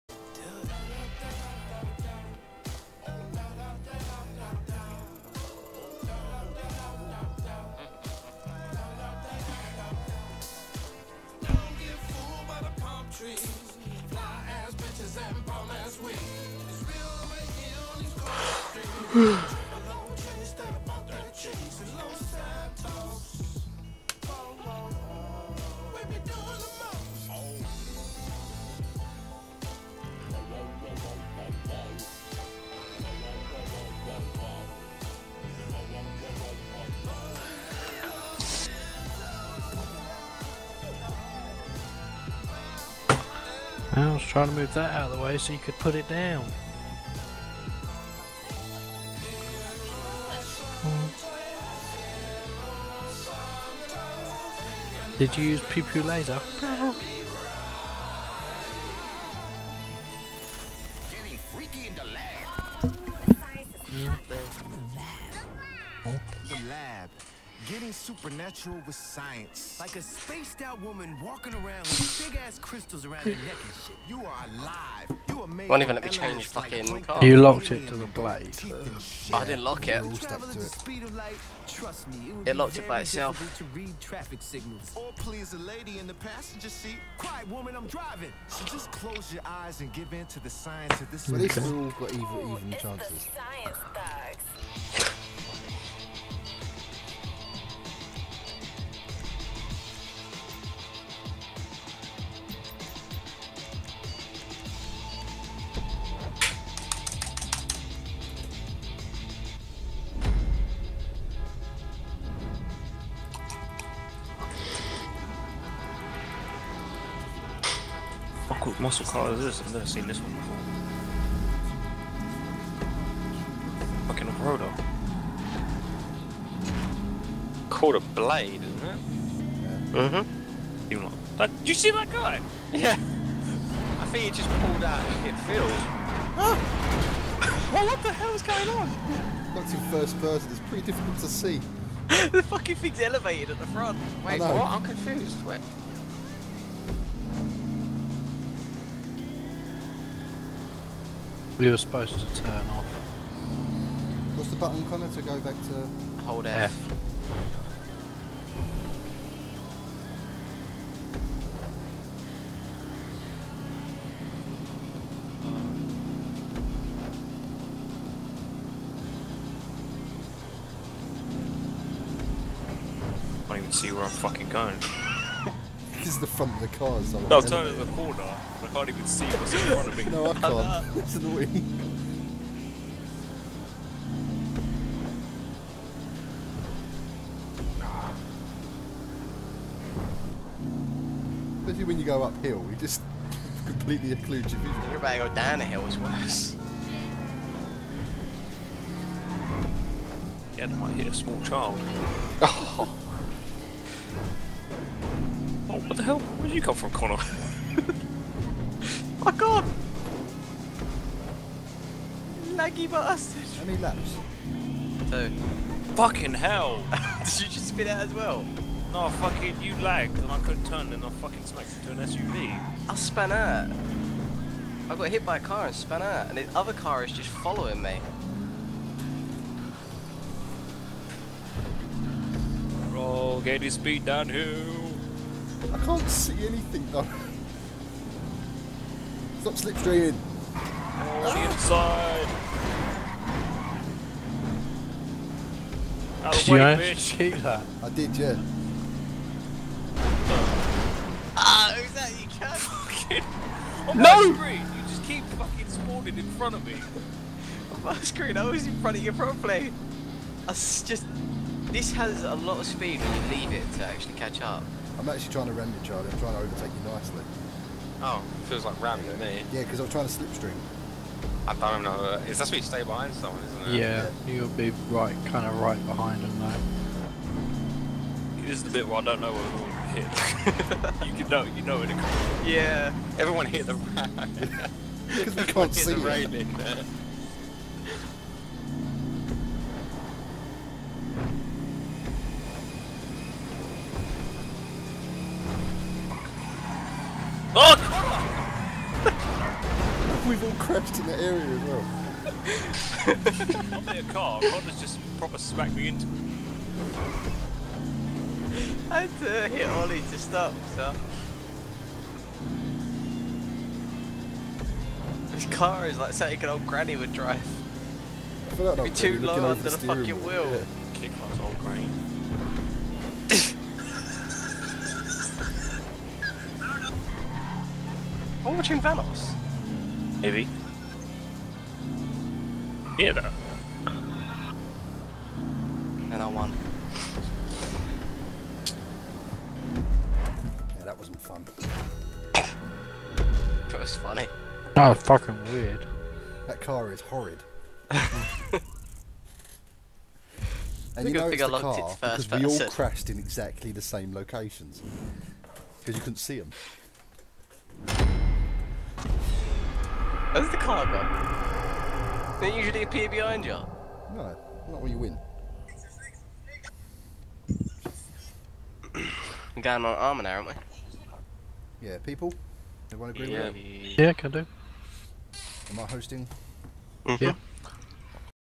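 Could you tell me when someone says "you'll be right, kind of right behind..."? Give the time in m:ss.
4:34.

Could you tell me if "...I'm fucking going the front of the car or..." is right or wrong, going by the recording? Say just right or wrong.
right.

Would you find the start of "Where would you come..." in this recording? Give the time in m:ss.
3:26.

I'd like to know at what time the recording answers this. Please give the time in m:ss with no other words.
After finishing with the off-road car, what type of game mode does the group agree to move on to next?
6:09.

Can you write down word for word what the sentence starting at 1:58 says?
What cool muscle car is this?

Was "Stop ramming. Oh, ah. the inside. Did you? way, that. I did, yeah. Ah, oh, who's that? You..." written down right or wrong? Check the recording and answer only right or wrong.
wrong.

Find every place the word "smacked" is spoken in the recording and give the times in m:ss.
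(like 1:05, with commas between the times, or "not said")
3:41, 5:05.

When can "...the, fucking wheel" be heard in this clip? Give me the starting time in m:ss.
5:19.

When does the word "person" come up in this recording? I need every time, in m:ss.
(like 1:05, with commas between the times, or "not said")
2:20, 5:52.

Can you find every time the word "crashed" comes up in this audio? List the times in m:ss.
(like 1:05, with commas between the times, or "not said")
5:00, 5:52.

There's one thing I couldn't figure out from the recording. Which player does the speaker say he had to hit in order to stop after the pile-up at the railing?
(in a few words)
Ollie.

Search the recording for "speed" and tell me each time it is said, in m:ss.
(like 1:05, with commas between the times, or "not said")
3:53, 4:22.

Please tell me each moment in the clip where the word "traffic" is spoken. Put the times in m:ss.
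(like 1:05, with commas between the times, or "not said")
1:24.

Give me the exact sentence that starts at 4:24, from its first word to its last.
I'm actually trying to ram you, Charlie.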